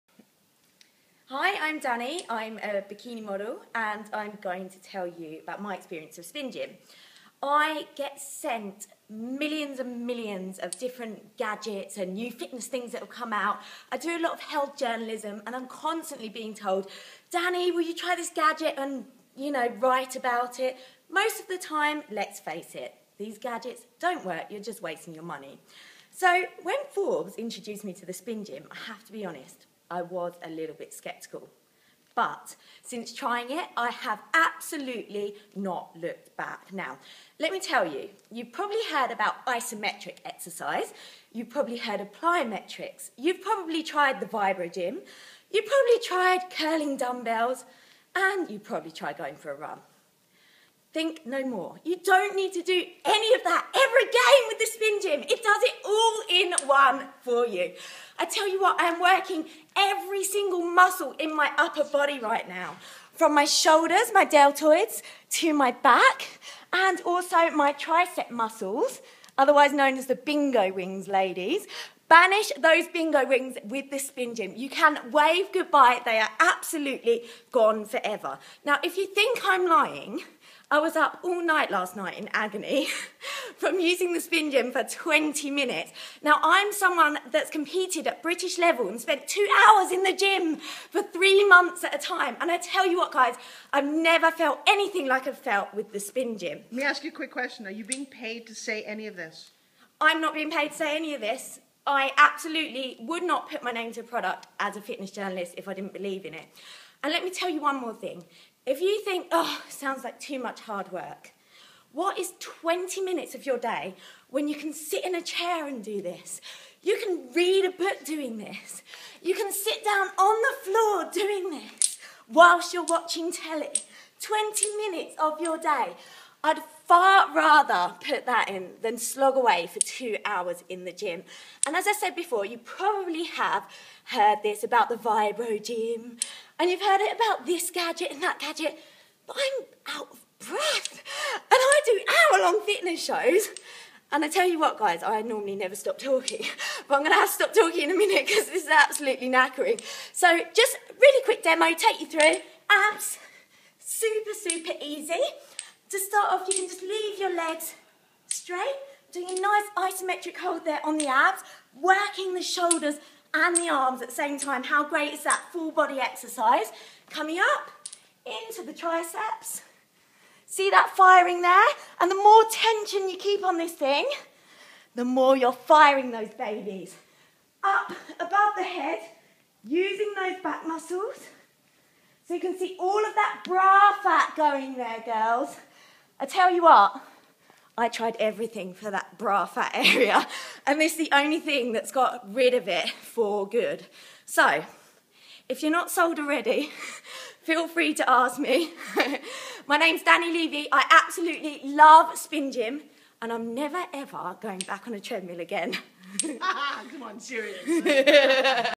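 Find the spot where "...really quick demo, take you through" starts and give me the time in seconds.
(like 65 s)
150 s.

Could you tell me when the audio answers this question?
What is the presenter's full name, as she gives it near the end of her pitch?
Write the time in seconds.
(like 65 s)
200 s.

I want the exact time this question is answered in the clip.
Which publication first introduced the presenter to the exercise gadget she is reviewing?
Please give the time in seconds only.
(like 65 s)
26 s.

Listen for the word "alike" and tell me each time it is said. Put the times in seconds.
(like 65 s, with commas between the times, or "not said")
not said.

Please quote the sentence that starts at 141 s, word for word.
And I do hour long fitness shows.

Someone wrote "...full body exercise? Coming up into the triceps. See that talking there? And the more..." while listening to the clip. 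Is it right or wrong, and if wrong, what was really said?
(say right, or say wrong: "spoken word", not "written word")
wrong: "firing", not "talking".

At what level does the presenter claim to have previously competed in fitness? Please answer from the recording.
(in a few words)
British level.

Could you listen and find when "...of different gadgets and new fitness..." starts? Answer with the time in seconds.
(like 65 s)
10 s.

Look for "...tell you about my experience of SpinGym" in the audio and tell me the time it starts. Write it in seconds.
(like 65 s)
4 s.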